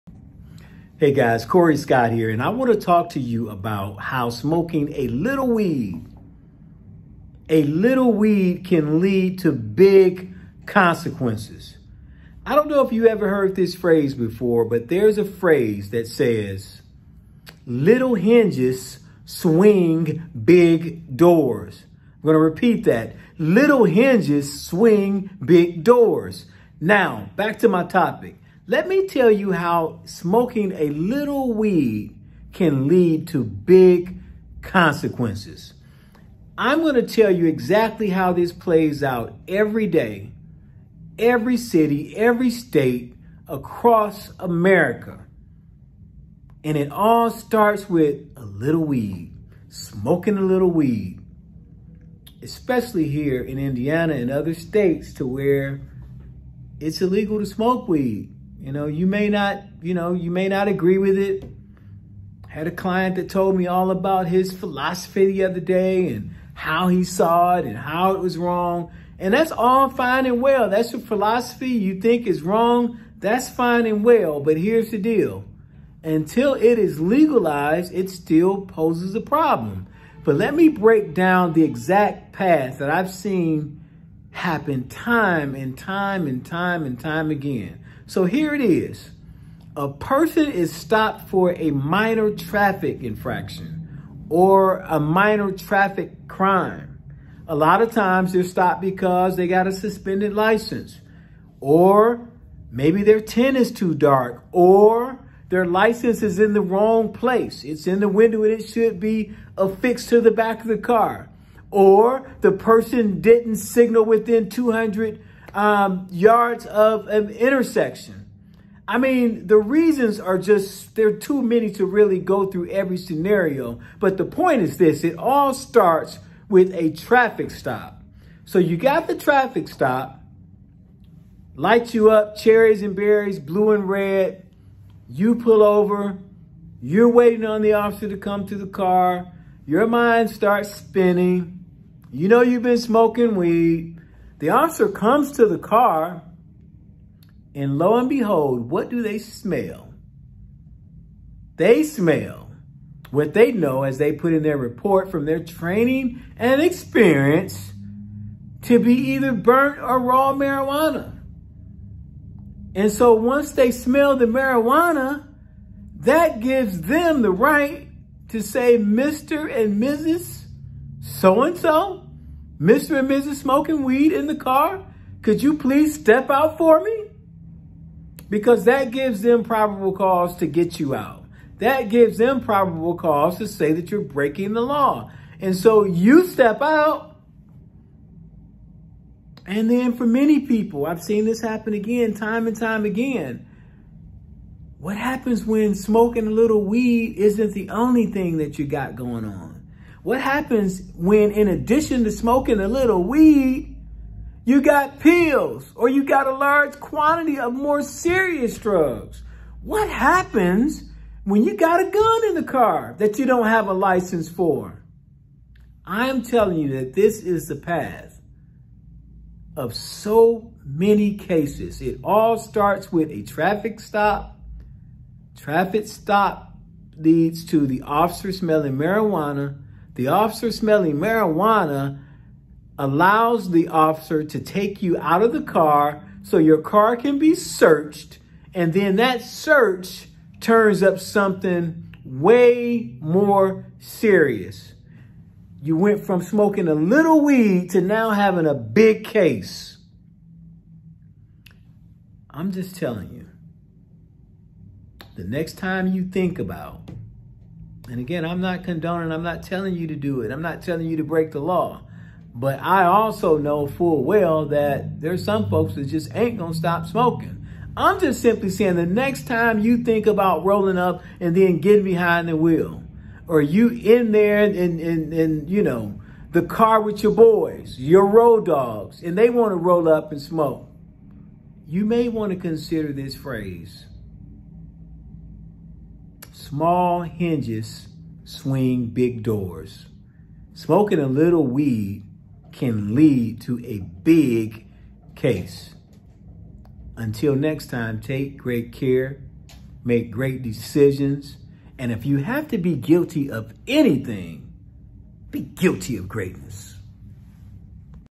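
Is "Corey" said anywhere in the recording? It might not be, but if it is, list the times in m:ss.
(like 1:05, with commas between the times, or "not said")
0:01.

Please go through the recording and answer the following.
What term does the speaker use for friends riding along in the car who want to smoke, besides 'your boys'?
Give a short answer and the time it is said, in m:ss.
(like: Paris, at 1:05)
road dogs, at 4:38.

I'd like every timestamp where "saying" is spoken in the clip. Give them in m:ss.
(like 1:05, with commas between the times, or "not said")
4:28.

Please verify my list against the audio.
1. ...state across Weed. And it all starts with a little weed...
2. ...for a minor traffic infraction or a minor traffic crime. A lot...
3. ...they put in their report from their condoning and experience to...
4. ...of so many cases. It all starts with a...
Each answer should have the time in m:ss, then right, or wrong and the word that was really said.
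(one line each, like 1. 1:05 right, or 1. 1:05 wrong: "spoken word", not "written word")
1. 0:42 wrong: "America", not "Weed"
2. 1:31 right
3. 2:33 wrong: "training", not "condoning"
4. 3:39 right.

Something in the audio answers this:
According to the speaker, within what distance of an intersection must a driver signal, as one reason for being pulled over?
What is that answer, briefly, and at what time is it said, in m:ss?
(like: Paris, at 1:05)
200 yards, at 1:54.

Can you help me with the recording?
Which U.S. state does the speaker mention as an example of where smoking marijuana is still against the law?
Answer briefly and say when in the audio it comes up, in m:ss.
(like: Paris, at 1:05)
Indiana, at 0:53.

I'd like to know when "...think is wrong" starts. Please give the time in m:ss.
1:12.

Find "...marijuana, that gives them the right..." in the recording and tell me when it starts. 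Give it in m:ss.
2:44.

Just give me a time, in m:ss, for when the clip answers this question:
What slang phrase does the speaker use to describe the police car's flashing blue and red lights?
2:12.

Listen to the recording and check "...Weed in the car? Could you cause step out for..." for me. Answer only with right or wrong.
wrong.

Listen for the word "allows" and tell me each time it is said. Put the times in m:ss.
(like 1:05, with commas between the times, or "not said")
3:52.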